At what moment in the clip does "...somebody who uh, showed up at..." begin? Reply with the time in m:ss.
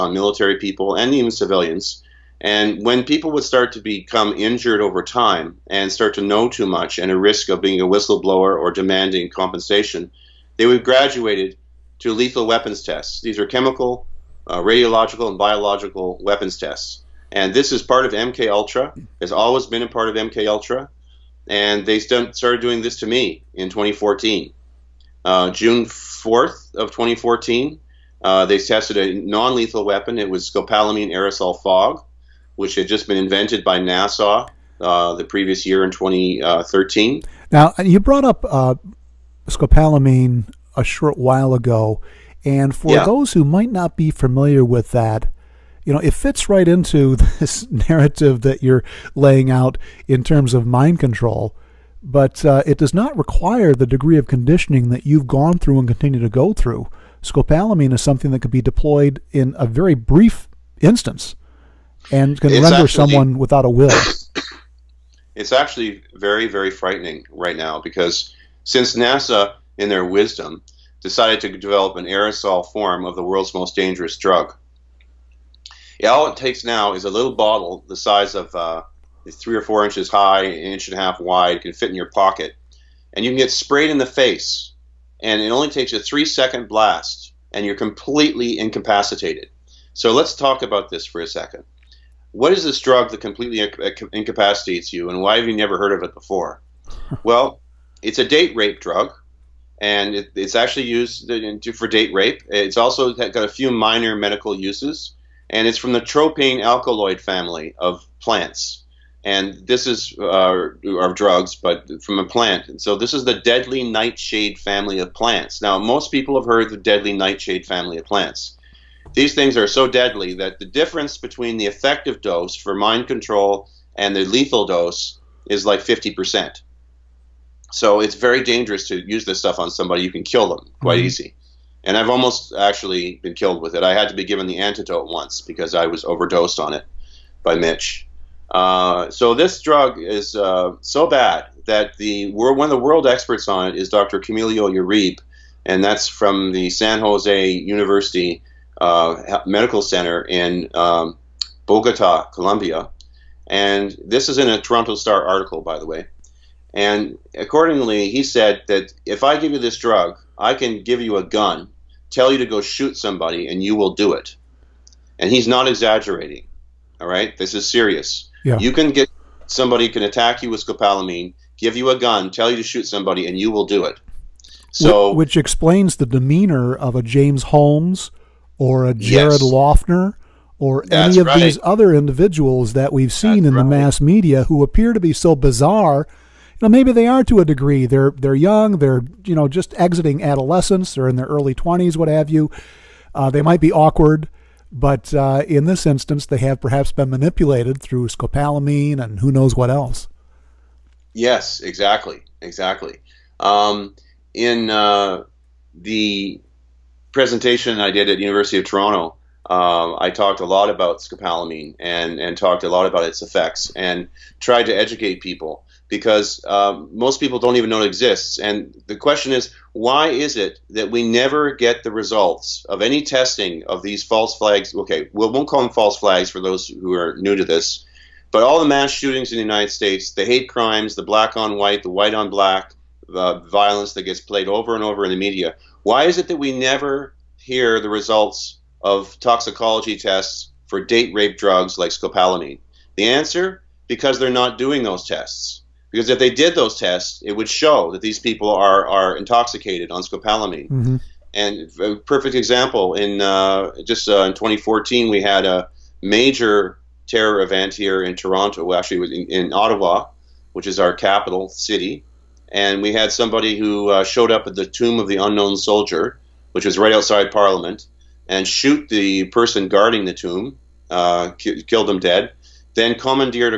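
4:23.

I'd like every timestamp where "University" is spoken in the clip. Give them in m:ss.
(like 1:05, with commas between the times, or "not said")
2:27, 3:28.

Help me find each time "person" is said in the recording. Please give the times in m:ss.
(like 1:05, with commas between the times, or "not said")
4:29.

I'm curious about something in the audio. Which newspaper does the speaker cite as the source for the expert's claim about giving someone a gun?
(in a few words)
Toronto Star.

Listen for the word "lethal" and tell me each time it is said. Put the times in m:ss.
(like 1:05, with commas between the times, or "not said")
0:12, 0:29, 2:04.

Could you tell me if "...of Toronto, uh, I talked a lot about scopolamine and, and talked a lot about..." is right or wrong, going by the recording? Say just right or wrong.
right.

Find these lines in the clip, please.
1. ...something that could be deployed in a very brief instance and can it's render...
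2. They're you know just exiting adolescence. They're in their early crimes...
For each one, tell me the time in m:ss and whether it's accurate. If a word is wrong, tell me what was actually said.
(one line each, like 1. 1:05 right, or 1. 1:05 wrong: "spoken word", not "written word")
1. 0:58 right
2. 3:08 wrong: "twenties", not "crimes".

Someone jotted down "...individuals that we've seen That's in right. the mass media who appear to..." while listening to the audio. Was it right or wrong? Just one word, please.
right.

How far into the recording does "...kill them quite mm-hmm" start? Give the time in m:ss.
2:10.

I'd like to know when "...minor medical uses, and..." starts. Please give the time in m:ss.
1:43.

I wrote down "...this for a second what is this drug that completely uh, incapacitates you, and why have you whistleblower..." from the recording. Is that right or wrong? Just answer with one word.
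wrong.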